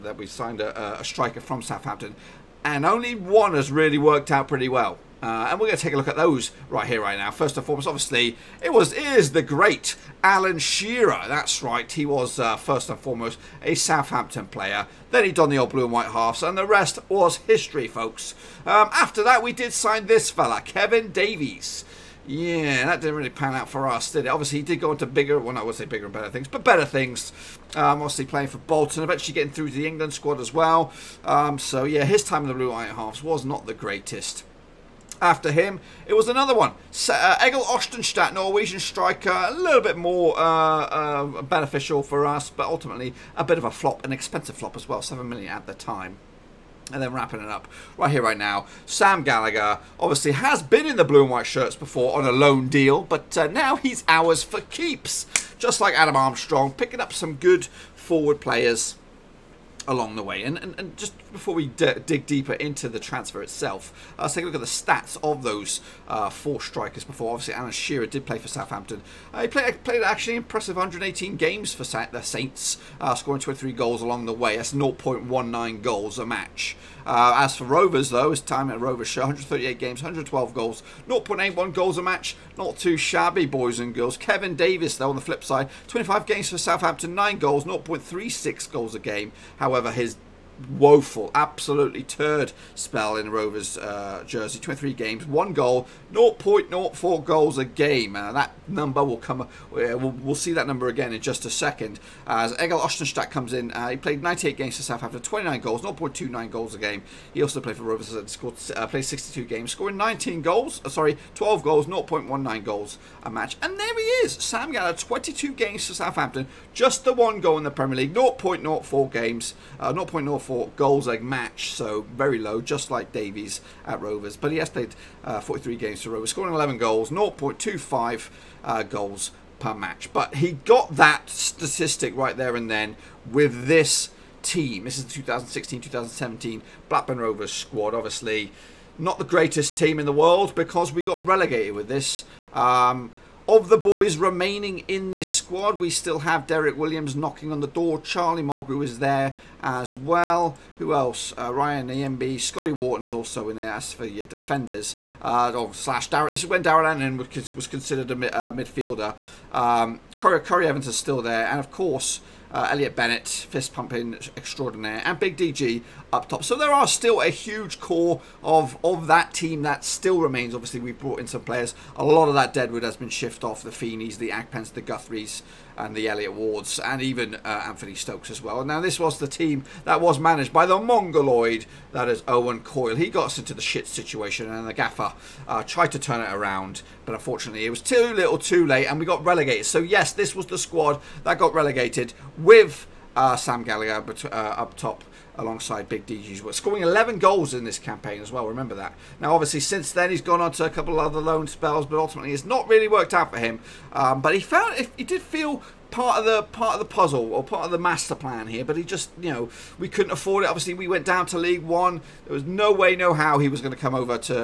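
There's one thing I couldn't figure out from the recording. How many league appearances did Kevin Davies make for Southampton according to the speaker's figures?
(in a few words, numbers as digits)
25.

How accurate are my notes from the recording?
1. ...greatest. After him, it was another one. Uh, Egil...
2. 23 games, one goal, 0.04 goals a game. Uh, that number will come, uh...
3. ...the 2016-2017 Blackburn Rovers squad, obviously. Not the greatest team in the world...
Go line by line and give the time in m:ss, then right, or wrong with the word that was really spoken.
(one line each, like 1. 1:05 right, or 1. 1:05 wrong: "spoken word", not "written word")
1. 0:33 right
2. 1:34 right
3. 2:15 right.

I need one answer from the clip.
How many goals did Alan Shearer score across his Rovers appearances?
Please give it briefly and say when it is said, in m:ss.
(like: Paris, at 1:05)
112, at 1:20.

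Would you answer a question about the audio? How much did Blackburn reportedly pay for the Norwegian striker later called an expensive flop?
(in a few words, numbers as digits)
7 million.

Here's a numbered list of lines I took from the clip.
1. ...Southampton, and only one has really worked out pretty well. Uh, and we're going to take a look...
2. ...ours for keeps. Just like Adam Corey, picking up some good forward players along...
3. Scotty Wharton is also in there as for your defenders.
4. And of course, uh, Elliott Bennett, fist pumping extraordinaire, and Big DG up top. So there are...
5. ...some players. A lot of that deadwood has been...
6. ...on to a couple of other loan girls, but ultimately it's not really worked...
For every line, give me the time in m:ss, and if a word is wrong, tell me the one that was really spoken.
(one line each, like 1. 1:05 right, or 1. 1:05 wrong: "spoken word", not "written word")
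1. 0:01 right
2. 0:54 wrong: "Armstrong", not "Corey"
3. 2:32 right
4. 2:41 right
5. 2:51 right
6. 3:20 wrong: "spells", not "girls".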